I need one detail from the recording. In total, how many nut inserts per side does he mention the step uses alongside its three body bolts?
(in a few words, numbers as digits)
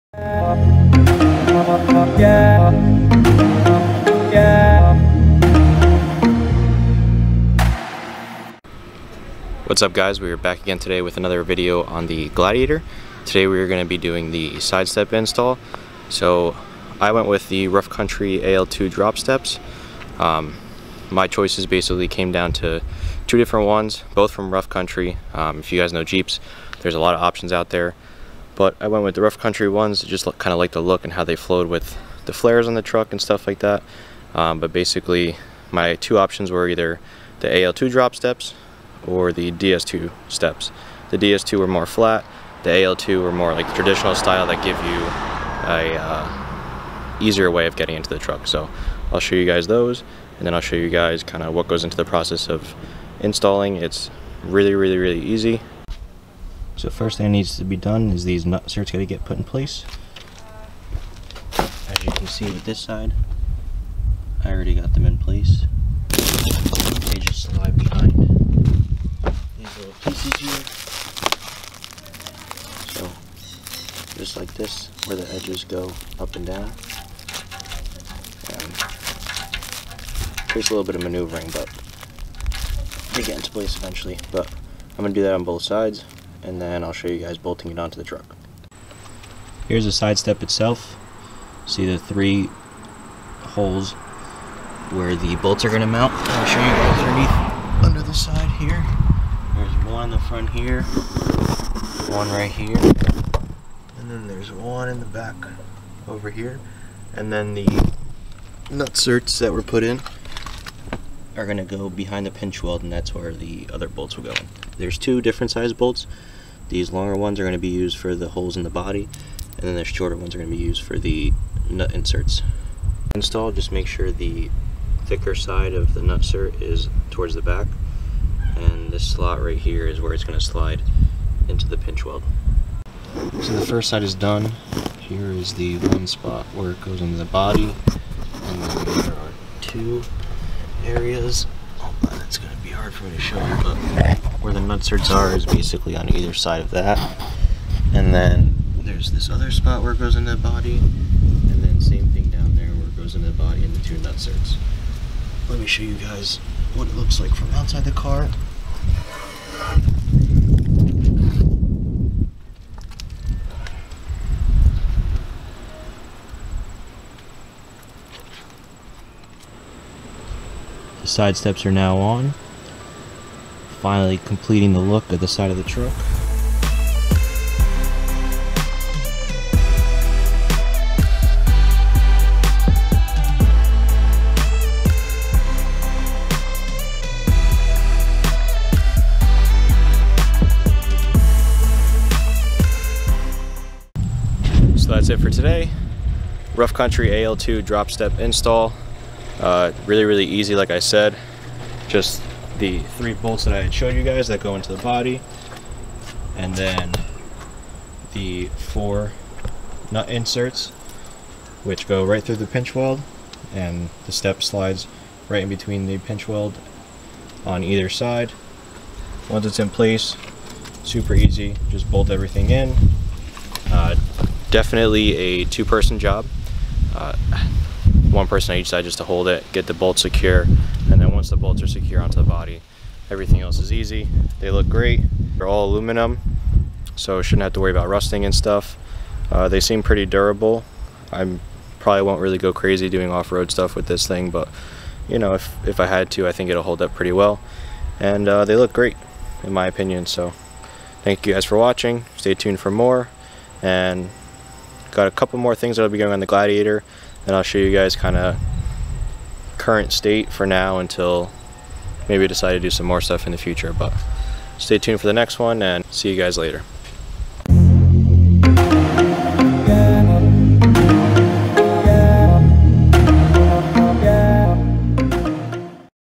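4.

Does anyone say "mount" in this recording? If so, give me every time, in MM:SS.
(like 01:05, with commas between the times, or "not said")
01:35.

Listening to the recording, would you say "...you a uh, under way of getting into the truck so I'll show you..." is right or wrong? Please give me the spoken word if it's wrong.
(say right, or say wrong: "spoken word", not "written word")
wrong: "easier", not "under".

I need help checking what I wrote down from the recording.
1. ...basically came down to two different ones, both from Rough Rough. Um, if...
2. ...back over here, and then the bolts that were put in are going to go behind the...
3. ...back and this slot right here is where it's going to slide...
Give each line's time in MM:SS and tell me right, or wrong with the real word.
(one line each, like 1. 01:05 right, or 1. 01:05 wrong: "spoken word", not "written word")
1. 00:21 wrong: "Country", not "Rough"
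2. 01:45 wrong: "nutserts", not "bolts"
3. 02:07 right.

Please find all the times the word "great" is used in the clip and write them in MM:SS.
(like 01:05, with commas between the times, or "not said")
03:54, 04:08.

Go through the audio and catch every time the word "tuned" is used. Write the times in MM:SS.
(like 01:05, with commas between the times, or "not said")
04:12, 04:24.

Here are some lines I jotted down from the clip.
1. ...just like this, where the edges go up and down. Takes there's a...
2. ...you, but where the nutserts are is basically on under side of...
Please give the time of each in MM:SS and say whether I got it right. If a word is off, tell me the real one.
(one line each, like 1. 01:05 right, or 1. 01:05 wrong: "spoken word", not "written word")
1. 01:14 right
2. 02:23 wrong: "either", not "under".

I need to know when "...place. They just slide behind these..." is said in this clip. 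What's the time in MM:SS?
01:05.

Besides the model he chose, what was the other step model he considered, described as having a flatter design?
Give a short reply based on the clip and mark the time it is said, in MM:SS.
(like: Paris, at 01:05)
DS2, at 00:39.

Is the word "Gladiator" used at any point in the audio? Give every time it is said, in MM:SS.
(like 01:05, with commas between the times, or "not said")
00:12, 04:16.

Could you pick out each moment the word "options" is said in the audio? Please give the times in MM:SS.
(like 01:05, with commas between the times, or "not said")
00:27, 00:36.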